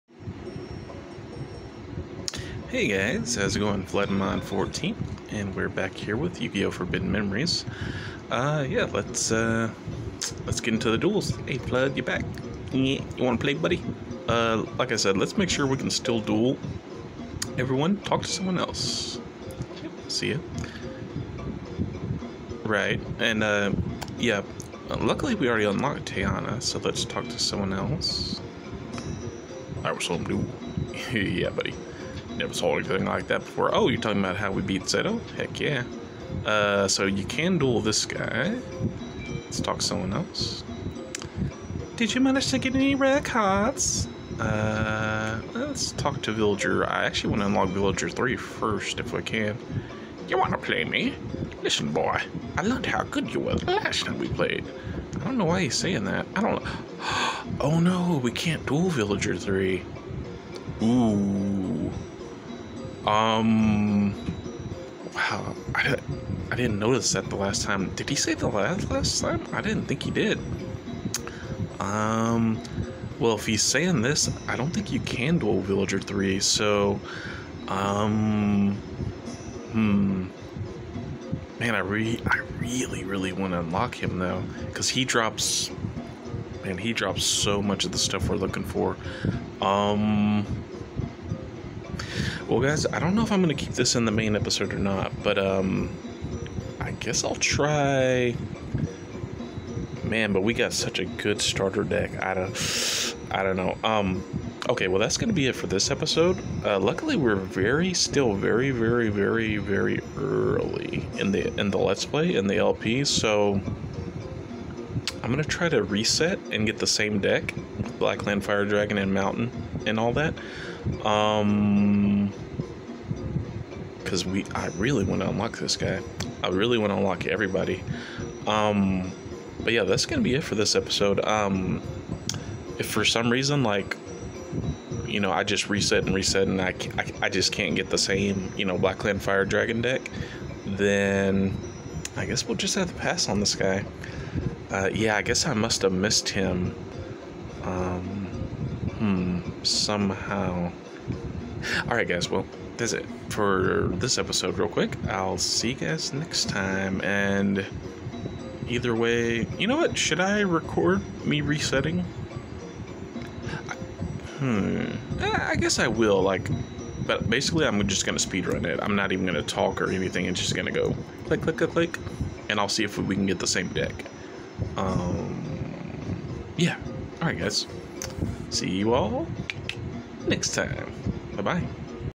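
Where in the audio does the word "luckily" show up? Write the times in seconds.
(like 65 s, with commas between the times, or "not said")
24 s, 106 s.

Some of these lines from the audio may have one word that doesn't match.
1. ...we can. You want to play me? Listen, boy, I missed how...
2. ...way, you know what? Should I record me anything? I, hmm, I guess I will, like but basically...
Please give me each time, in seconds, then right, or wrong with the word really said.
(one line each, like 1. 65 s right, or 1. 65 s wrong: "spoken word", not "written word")
1. 49 s wrong: "learned", not "missed"
2. 158 s wrong: "resetting", not "anything".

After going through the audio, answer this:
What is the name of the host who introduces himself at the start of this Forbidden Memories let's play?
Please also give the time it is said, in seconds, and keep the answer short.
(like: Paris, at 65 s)
Floodinmon14, at 3 s.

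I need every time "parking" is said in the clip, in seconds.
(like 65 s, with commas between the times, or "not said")
not said.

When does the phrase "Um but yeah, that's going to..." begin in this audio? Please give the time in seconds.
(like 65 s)
128 s.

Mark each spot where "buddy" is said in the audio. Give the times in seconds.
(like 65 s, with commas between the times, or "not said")
13 s, 31 s.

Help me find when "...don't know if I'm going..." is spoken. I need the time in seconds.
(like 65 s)
92 s.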